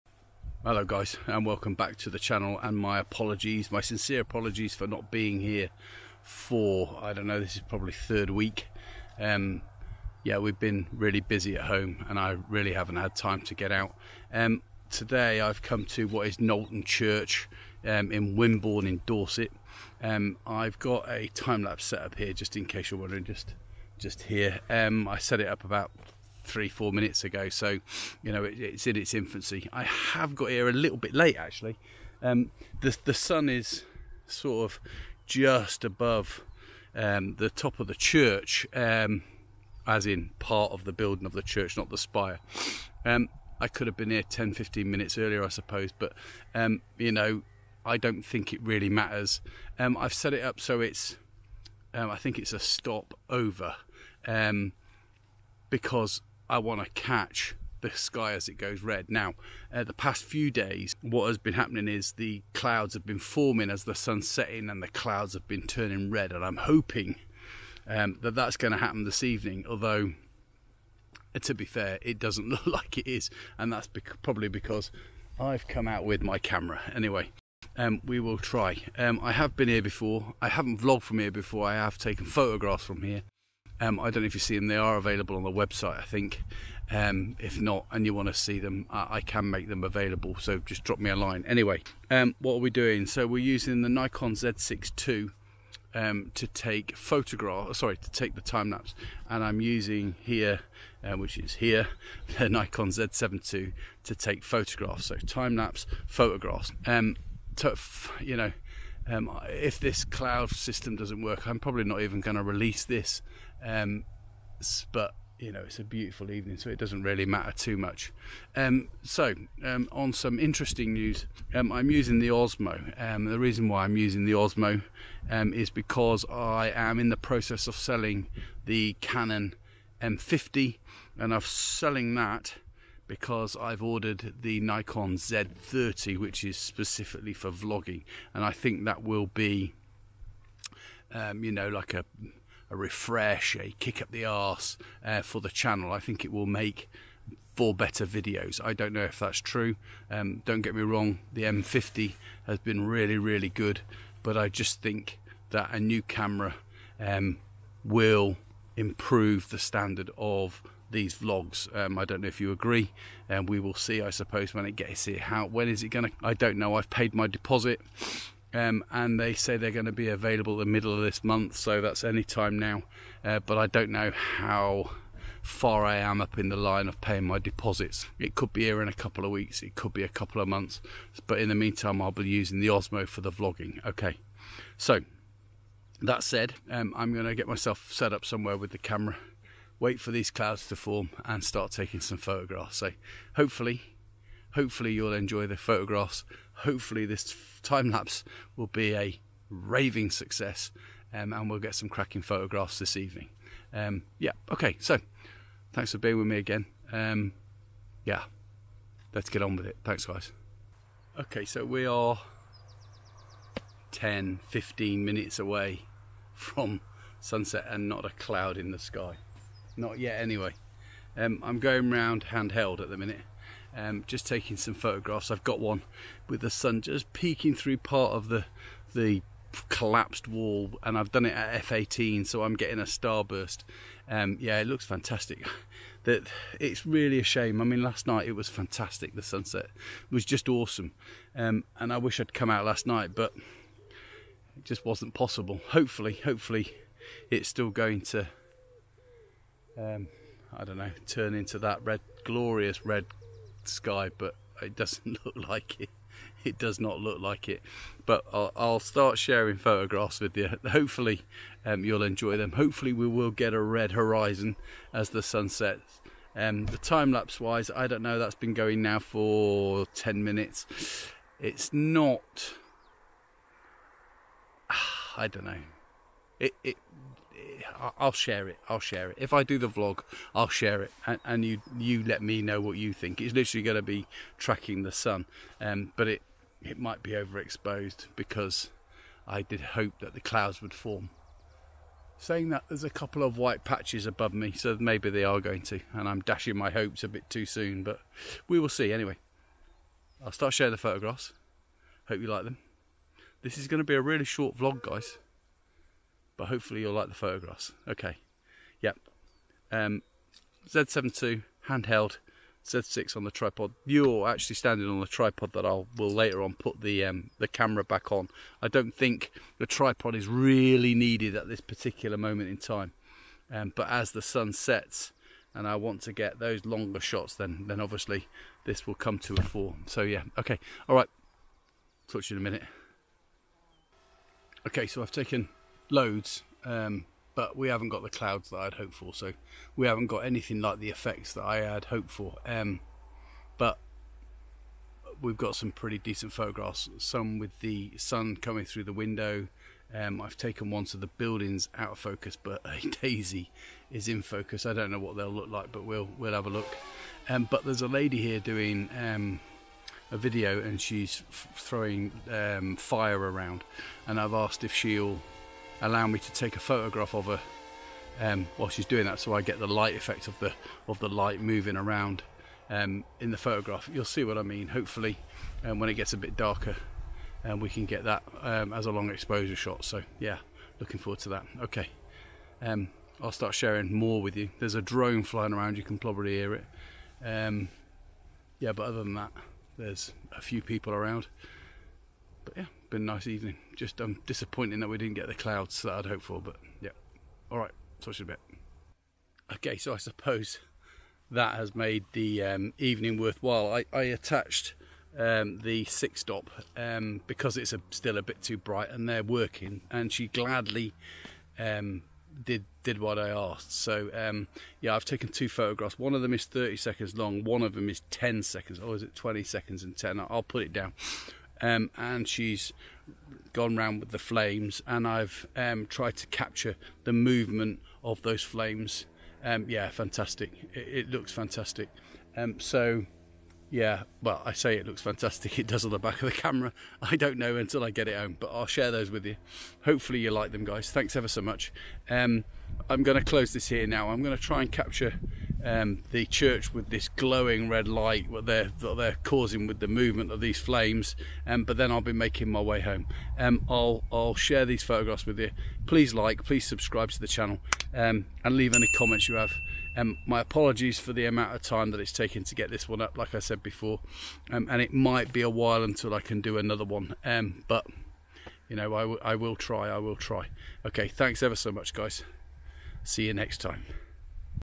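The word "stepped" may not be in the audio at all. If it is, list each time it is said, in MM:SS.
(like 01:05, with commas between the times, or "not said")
not said.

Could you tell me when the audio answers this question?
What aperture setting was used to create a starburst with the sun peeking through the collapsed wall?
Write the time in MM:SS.
03:51.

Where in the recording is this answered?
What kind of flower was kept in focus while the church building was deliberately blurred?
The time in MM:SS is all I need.
05:53.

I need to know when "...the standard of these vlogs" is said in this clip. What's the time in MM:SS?
02:39.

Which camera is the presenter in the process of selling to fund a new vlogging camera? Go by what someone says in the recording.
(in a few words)
Canon M50.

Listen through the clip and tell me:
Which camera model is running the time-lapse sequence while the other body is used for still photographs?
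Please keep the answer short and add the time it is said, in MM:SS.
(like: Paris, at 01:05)
Nikon Z6 II, at 01:33.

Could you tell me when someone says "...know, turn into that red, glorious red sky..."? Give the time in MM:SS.
04:10.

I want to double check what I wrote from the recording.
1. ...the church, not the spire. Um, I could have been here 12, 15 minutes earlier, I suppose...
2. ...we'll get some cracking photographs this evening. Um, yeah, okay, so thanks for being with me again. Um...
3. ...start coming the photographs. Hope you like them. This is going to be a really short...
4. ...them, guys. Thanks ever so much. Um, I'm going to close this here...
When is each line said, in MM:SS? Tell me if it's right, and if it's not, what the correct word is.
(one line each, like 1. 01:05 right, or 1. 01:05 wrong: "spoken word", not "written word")
1. 00:41 wrong: "10", not "12"
2. 03:21 right
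3. 05:00 wrong: "sharing", not "coming"
4. 07:20 right.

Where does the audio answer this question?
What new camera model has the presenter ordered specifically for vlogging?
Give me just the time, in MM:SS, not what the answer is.
02:14.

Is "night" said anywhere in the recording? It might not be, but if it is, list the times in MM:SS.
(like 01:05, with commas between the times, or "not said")
03:58, 04:02.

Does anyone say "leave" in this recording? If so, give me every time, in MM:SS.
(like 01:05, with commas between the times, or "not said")
07:38.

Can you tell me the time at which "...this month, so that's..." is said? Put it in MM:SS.
02:51.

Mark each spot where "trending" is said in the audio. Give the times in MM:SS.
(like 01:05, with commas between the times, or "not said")
not said.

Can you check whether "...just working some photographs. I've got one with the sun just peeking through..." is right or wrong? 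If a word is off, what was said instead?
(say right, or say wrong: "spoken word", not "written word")
wrong: "taking", not "working".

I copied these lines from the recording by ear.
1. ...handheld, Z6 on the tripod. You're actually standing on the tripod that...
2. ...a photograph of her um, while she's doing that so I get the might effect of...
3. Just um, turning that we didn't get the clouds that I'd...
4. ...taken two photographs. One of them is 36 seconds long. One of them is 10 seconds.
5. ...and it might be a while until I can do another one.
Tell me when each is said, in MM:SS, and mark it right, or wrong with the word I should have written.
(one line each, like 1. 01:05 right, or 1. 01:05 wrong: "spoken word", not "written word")
1. 05:11 right
2. 06:06 wrong: "light", not "might"
3. 06:33 wrong: "disappointing", not "turning"
4. 06:55 wrong: "30", not "36"
5. 07:44 right.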